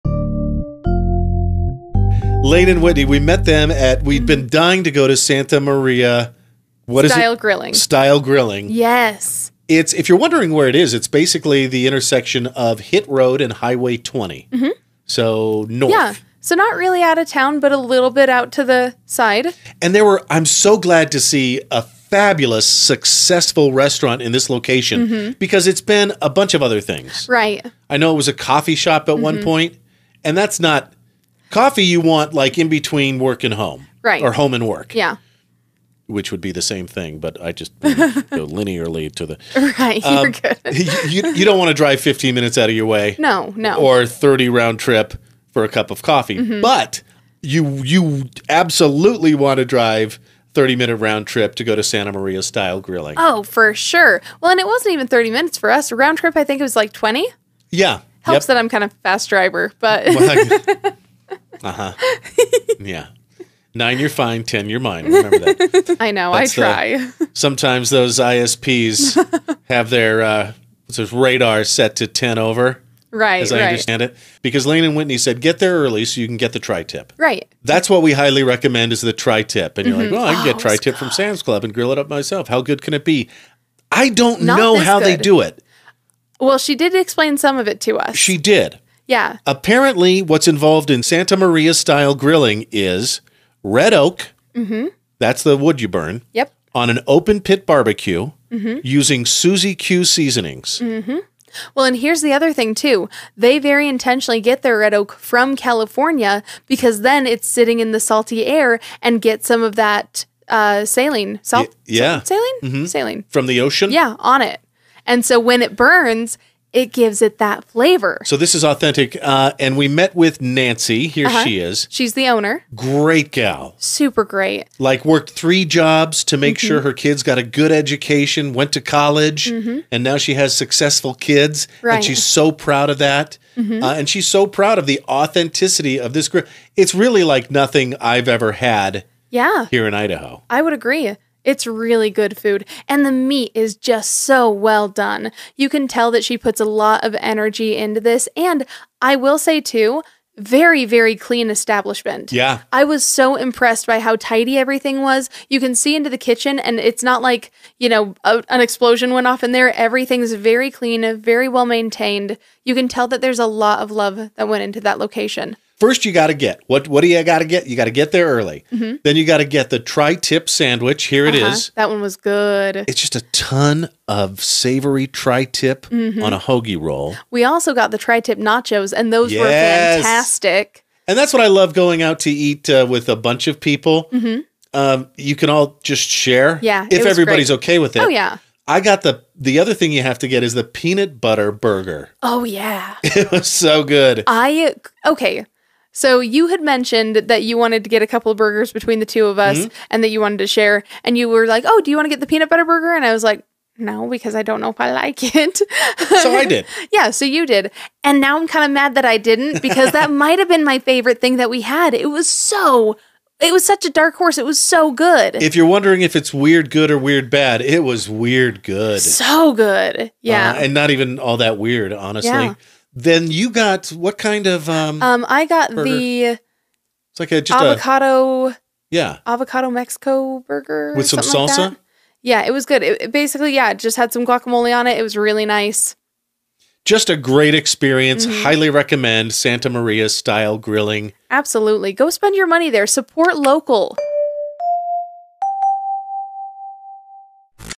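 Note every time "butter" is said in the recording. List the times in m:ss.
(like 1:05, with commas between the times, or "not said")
3:11, 3:22.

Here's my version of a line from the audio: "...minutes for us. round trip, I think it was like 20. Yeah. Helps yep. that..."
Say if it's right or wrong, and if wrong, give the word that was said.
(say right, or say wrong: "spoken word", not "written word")
right.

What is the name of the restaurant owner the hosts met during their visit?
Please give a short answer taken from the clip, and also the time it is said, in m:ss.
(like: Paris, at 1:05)
Nancy, at 2:00.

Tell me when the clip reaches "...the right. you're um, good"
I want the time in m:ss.
0:39.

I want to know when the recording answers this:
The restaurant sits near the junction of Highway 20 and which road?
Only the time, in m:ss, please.
0:12.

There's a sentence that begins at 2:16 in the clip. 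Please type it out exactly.
It's really like nothing I've ever had.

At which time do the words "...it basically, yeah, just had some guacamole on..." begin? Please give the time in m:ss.
3:53.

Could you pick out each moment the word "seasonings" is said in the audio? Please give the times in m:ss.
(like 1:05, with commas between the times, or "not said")
1:40.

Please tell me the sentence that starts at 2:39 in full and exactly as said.
Everything's very clean, very well maintained.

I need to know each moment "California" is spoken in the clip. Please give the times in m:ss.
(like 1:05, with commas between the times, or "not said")
1:45.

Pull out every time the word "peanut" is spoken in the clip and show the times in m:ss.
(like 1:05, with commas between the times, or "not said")
3:10, 3:22.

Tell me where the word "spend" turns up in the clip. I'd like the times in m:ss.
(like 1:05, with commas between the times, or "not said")
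4:02.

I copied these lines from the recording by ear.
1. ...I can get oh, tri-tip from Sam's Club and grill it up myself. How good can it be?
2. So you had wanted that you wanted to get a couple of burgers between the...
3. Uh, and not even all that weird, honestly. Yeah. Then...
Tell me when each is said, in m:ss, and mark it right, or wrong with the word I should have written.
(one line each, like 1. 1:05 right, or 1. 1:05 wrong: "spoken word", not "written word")
1. 1:20 right
2. 3:15 wrong: "mentioned", not "wanted"
3. 3:40 right.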